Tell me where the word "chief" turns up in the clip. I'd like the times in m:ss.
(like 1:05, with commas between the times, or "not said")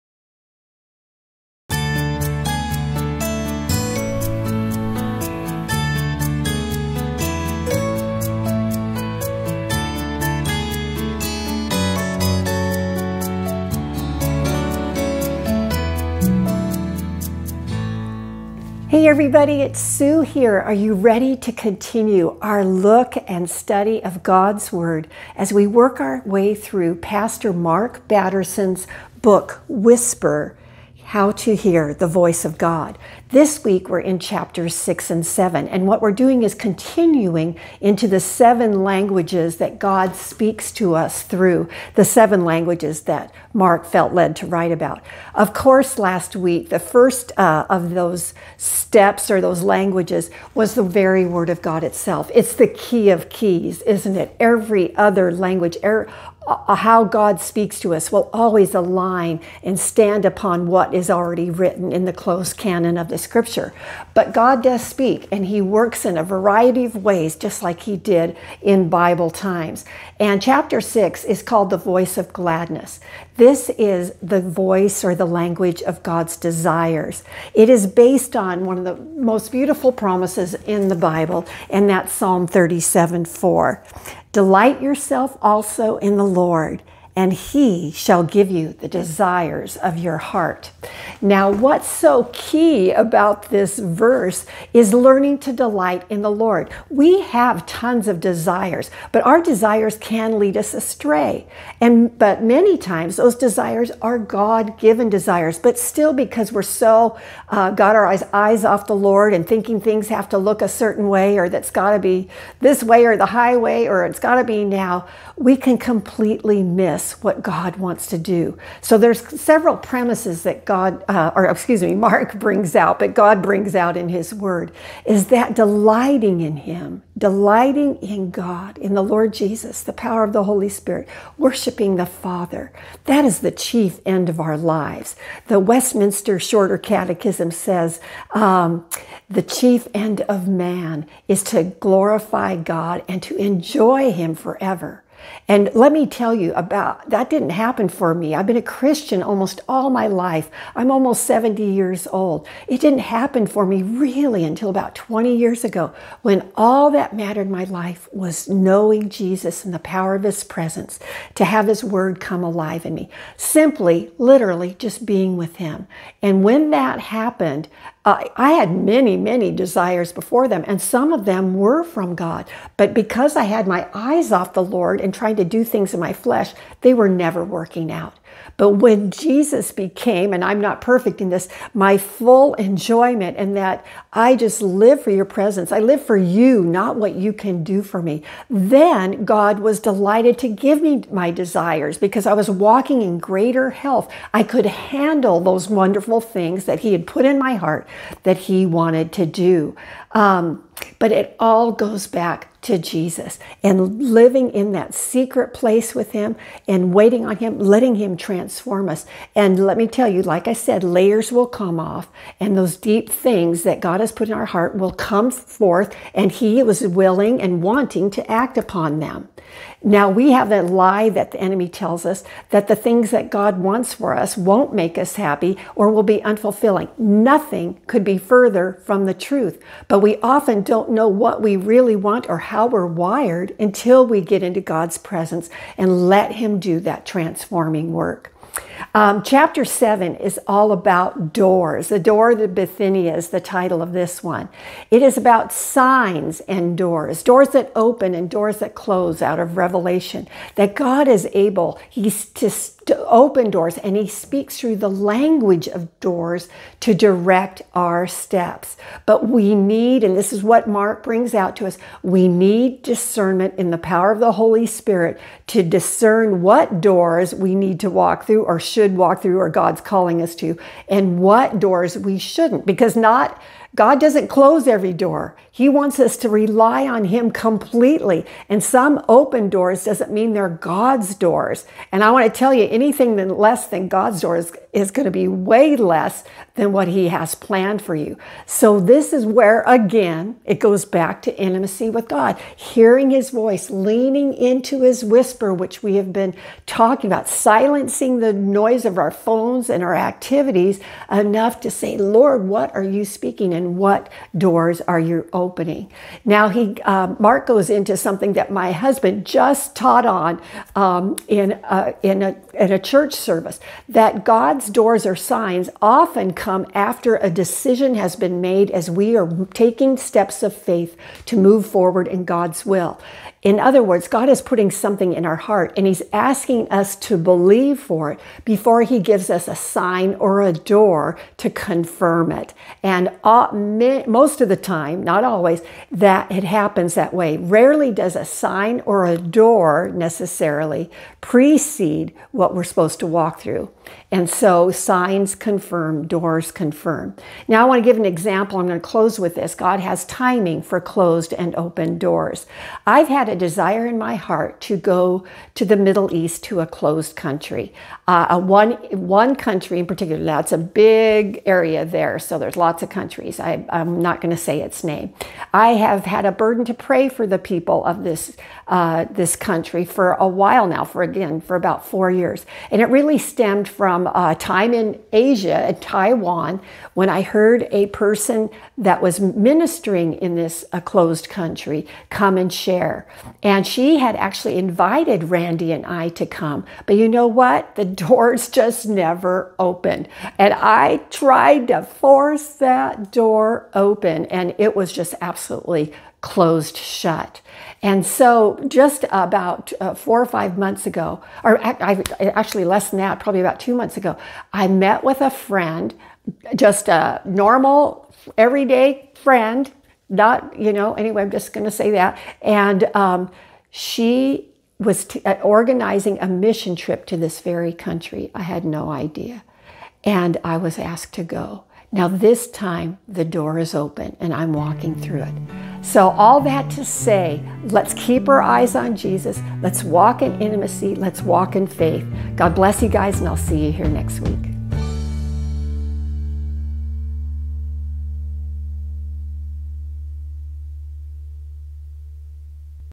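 2:13, 2:19.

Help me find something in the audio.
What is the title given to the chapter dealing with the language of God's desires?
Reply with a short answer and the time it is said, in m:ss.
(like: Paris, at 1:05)
The voice of gladness, at 1:11.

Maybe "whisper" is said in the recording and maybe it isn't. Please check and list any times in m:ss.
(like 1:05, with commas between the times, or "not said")
0:29, 4:55.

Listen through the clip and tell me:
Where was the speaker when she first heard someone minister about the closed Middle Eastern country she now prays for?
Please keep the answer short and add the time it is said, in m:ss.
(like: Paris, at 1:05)
Taiwan, at 6:15.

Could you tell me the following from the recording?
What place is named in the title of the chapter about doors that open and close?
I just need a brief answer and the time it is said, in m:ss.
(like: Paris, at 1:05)
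Bithynia, at 4:02.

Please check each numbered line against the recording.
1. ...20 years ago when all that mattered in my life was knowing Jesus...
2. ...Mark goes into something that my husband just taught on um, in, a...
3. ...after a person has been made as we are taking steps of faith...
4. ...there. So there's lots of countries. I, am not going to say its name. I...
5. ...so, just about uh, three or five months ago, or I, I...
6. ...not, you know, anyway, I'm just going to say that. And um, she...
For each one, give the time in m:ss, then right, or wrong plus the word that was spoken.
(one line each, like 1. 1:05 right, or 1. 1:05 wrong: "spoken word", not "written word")
1. 2:34 right
2. 5:07 right
3. 5:16 wrong: "decision", not "person"
4. 6:01 right
5. 6:38 wrong: "four", not "three"
6. 6:50 right.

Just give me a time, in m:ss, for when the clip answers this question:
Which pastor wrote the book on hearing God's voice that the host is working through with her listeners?
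0:27.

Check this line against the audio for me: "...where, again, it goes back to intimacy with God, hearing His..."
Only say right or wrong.
right.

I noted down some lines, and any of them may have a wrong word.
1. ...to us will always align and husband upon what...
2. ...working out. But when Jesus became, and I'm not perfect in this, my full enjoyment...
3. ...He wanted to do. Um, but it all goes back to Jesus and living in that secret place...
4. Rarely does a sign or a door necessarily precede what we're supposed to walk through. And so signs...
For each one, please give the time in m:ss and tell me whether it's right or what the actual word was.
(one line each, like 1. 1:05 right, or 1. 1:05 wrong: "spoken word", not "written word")
1. 0:57 wrong: "stand", not "husband"
2. 2:57 right
3. 3:18 right
4. 5:37 right.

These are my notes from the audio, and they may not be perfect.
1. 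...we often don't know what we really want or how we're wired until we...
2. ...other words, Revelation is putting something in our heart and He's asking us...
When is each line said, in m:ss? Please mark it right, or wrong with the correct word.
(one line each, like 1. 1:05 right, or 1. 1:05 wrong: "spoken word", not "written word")
1. 3:49 right
2. 5:23 wrong: "God", not "Revelation".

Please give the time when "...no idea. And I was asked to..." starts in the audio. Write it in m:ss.
6:58.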